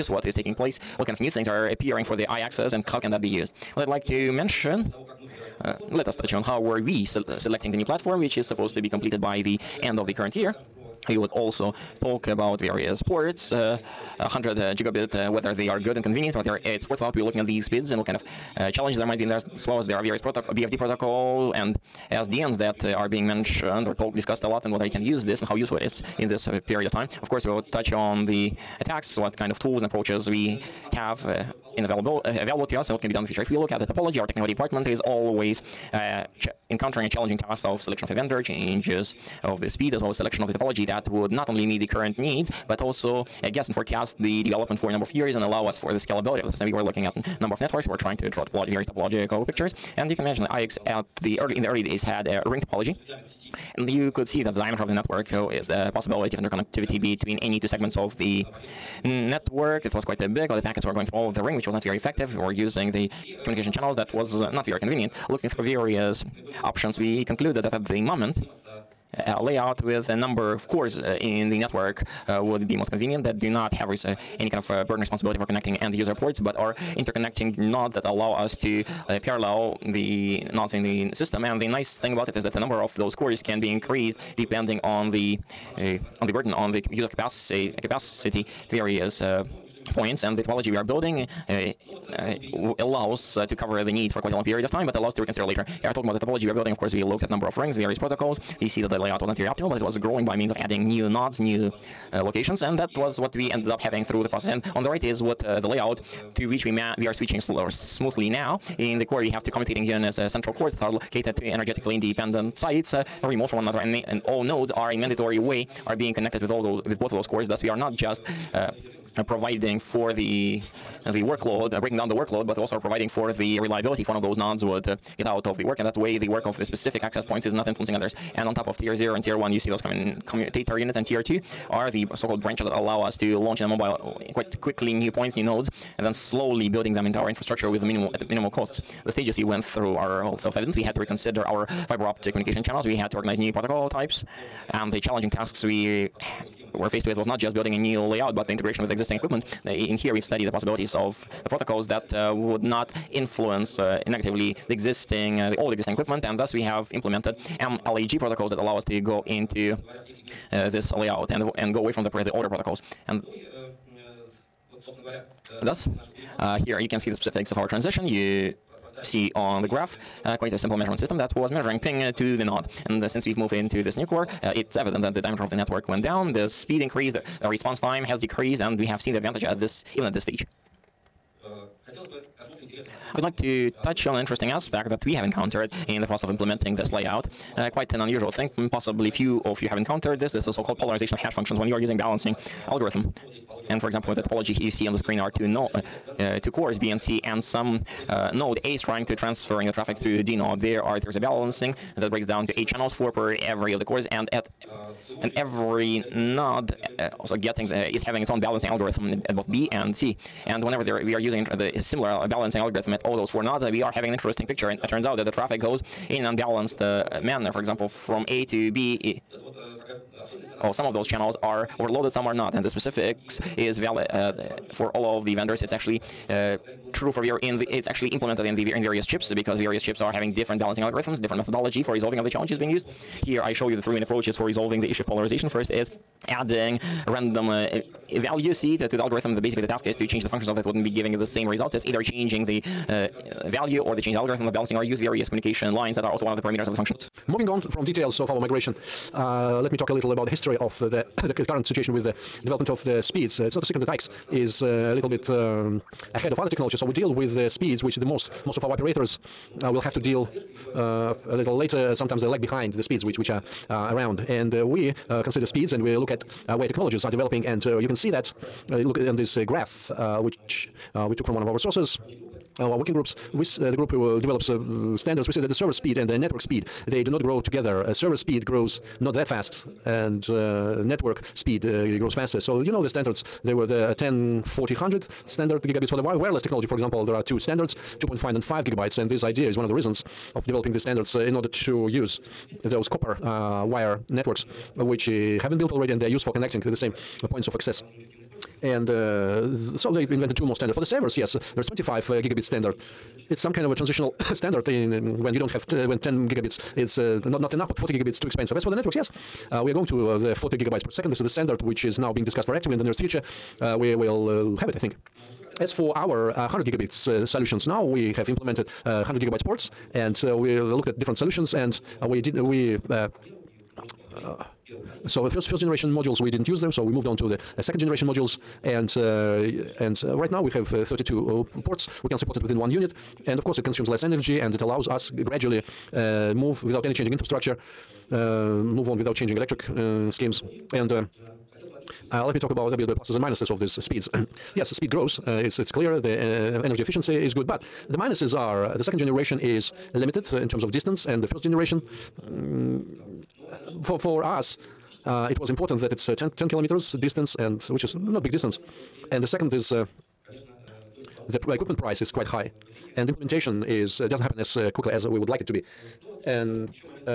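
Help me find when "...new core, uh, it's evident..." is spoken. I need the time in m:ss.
2:53.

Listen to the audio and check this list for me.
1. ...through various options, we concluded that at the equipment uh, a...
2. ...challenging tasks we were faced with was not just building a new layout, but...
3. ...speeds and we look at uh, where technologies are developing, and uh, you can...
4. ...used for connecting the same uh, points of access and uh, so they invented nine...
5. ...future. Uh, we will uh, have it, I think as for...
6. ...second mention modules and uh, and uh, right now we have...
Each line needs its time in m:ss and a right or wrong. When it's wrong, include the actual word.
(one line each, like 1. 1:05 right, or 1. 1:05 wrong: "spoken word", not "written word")
1. 1:05 wrong: "moment", not "equipment"
2. 2:24 right
3. 4:25 right
4. 4:56 wrong: "two", not "nine"
5. 5:12 right
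6. 5:27 wrong: "generation", not "mention".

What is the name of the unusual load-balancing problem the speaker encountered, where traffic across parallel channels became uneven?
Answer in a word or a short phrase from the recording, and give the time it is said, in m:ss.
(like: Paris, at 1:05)
Polarization of hash functions, at 3:10.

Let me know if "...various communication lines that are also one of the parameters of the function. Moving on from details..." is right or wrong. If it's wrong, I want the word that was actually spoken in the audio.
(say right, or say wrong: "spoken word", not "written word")
right.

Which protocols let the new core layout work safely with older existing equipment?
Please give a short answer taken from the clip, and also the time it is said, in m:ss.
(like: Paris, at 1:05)
MLAG, at 2:37.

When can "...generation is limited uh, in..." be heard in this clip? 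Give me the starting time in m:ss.
5:48.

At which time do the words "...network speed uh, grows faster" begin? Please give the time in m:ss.
4:40.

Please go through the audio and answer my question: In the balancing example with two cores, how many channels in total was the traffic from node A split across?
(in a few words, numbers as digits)
8.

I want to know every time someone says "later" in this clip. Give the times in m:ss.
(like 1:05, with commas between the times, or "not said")
1:35, 4:21.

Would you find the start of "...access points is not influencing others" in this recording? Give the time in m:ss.
2:07.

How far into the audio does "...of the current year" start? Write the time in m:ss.
0:09.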